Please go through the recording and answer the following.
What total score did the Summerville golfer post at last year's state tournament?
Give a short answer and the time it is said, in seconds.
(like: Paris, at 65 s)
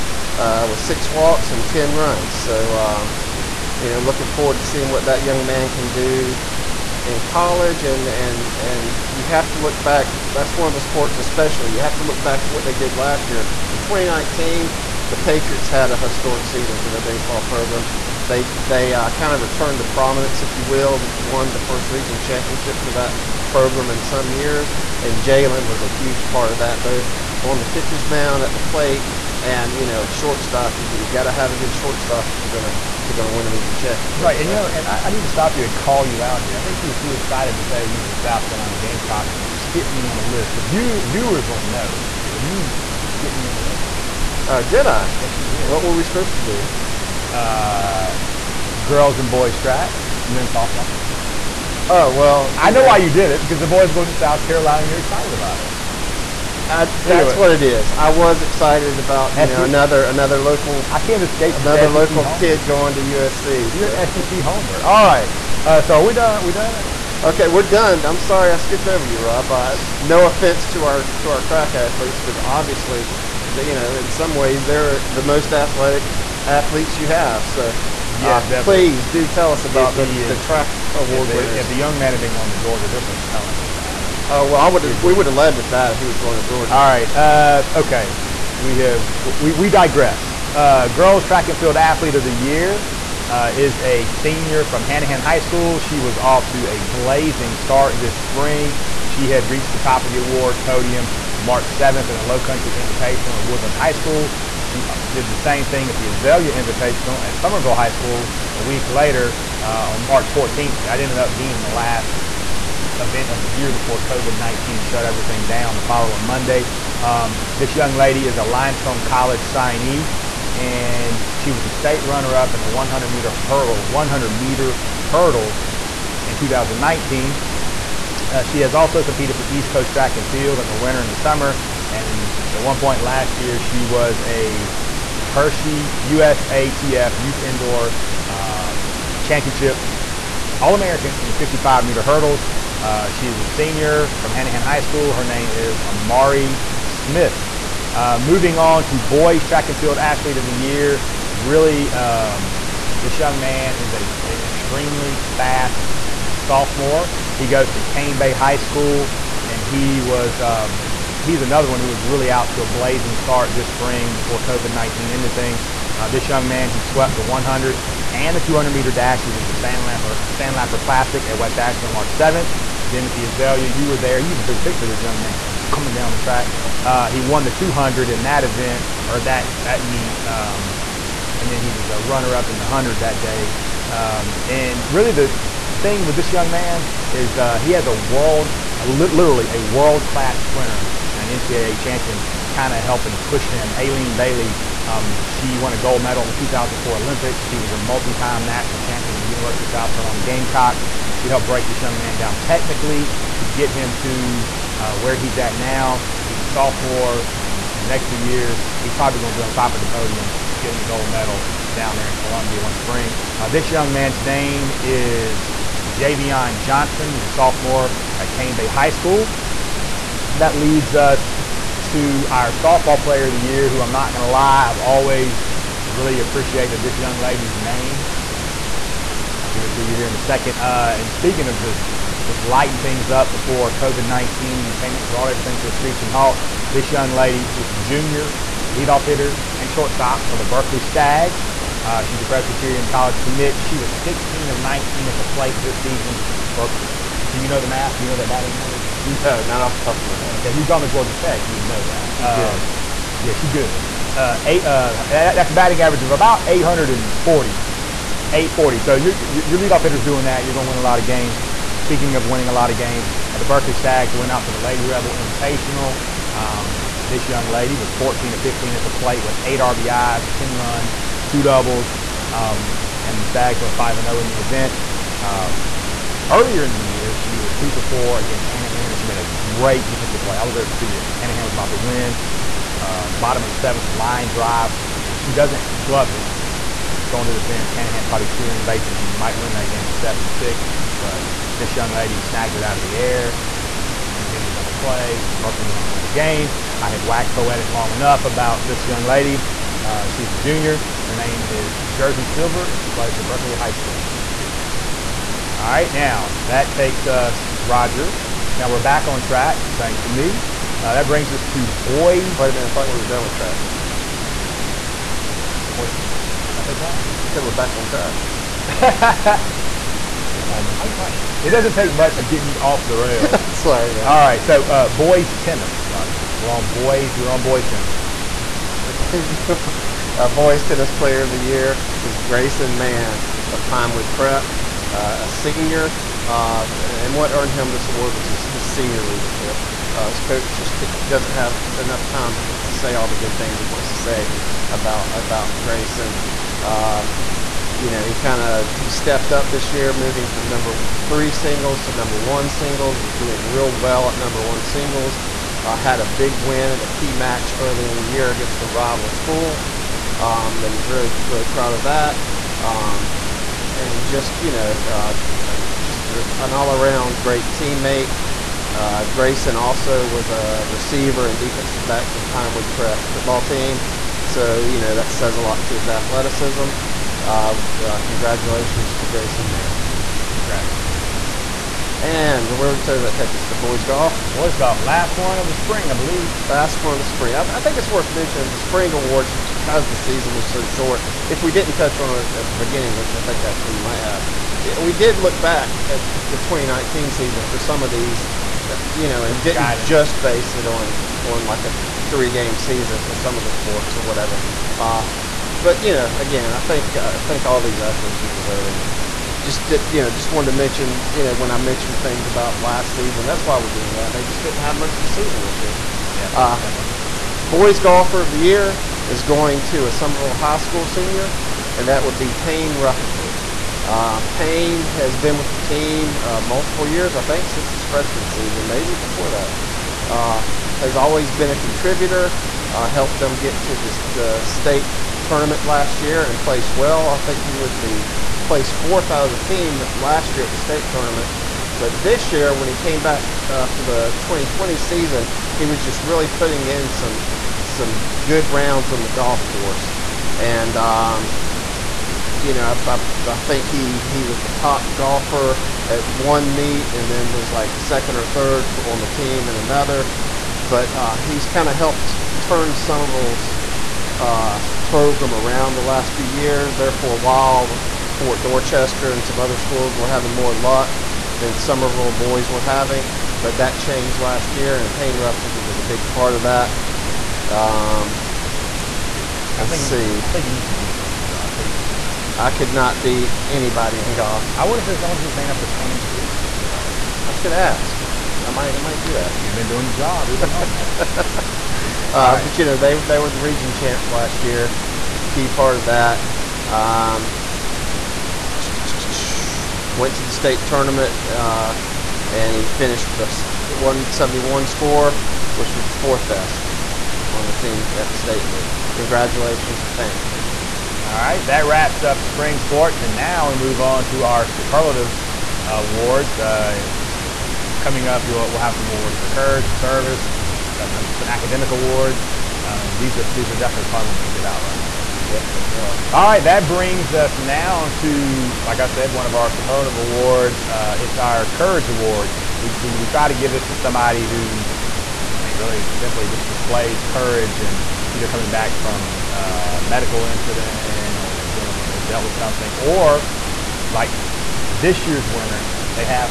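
171, at 503 s.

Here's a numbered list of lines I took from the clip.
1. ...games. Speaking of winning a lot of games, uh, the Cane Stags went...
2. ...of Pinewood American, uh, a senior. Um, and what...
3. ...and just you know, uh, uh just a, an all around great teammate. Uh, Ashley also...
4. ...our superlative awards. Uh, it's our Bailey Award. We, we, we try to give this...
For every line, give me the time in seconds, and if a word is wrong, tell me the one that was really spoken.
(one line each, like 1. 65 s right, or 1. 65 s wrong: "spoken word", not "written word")
1. 261 s wrong: "Berkeley", not "Cane"
2. 333 s wrong: "Prep", not "American"
3. 363 s wrong: "Grayson", not "Ashley"
4. 529 s wrong: "Courage", not "Bailey".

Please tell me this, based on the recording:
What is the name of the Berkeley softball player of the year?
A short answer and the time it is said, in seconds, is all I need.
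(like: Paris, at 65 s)
Jersey Silver, at 301 s.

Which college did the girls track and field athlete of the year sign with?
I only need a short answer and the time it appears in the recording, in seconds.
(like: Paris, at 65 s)
Limestone College, at 118 s.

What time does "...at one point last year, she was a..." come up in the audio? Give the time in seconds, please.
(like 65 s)
132 s.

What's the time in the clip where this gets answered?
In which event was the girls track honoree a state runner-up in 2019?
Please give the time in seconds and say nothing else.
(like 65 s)
123 s.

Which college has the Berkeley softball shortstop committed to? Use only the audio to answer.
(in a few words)
Presbyterian College.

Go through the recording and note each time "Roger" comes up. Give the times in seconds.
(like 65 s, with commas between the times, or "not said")
307 s, 325 s, 524 s.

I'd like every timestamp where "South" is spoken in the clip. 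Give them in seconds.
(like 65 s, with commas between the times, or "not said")
38 s, 54 s, 199 s.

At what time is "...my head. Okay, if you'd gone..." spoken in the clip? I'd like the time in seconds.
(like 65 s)
250 s.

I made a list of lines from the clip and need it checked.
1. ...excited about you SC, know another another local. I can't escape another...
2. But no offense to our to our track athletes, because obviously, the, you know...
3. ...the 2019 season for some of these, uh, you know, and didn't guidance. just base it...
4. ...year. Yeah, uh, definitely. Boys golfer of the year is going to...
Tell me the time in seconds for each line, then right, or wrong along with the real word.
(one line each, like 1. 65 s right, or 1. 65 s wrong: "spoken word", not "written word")
1. 58 s right
2. 69 s right
3. 396 s right
4. 415 s right.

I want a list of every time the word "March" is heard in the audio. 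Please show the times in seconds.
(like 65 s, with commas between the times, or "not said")
101 s, 110 s, 171 s.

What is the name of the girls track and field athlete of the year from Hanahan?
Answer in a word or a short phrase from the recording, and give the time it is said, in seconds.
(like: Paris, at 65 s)
Amari Smith, at 145 s.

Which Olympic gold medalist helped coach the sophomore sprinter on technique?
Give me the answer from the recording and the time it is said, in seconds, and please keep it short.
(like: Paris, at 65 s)
Aleen Bailey, at 193 s.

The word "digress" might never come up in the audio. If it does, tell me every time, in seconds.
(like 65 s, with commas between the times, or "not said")
89 s.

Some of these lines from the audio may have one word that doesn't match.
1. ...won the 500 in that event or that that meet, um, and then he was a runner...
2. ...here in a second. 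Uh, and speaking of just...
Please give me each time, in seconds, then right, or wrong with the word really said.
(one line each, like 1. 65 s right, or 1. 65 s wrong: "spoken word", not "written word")
1. 177 s wrong: "200", not "500"
2. 229 s right.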